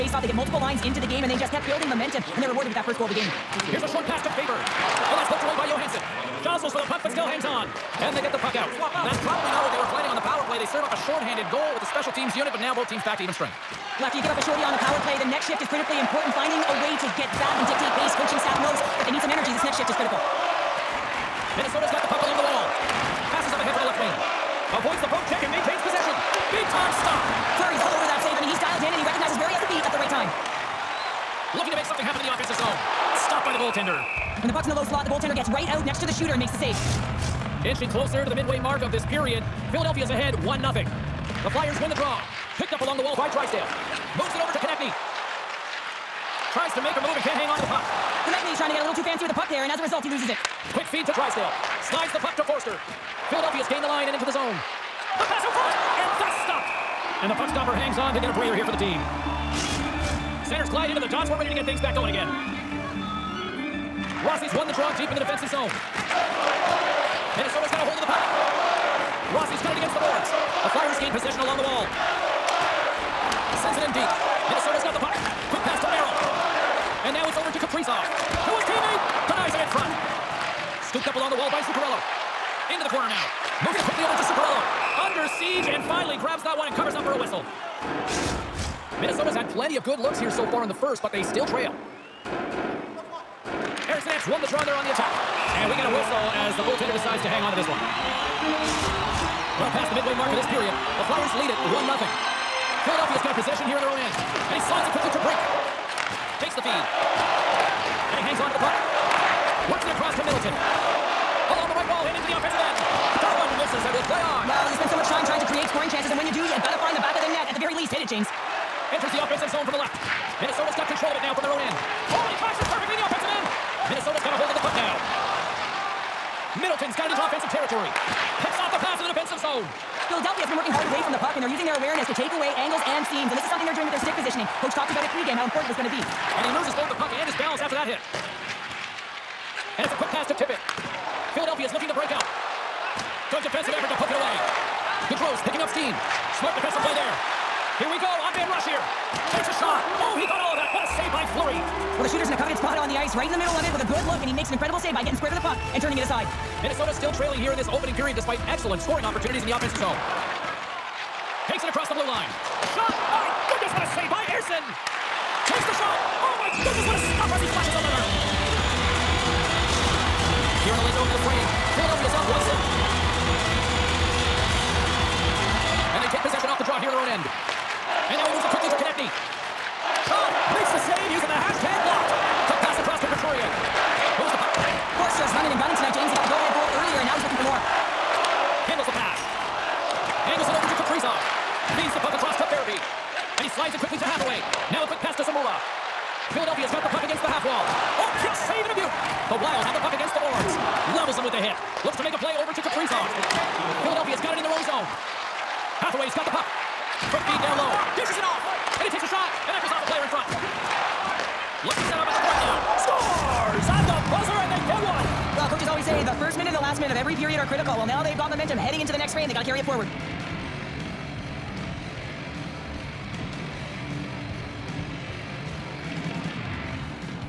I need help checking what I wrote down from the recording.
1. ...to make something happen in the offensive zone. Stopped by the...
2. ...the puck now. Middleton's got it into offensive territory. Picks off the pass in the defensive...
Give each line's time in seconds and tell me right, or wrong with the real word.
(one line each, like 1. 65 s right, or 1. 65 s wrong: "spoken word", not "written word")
1. 31 s right
2. 124 s right.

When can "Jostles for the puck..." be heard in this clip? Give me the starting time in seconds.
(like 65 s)
6 s.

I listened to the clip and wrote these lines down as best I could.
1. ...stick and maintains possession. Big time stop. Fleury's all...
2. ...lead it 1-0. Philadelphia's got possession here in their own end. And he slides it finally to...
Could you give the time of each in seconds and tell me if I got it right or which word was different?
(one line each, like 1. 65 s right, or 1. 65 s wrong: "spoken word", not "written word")
1. 25 s wrong: "check", not "stick"
2. 101 s wrong: "quickly", not "finally".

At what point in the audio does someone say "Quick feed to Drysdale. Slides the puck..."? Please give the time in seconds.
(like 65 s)
50 s.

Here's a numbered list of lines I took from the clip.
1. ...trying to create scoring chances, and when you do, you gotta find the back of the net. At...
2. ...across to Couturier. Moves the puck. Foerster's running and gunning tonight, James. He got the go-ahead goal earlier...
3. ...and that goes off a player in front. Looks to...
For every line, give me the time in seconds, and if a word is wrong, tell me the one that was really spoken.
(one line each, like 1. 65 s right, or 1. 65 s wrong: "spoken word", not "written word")
1. 115 s right
2. 182 s right
3. 209 s right.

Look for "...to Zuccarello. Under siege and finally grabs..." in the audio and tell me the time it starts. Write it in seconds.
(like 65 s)
84 s.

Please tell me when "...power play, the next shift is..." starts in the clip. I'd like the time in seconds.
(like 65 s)
14 s.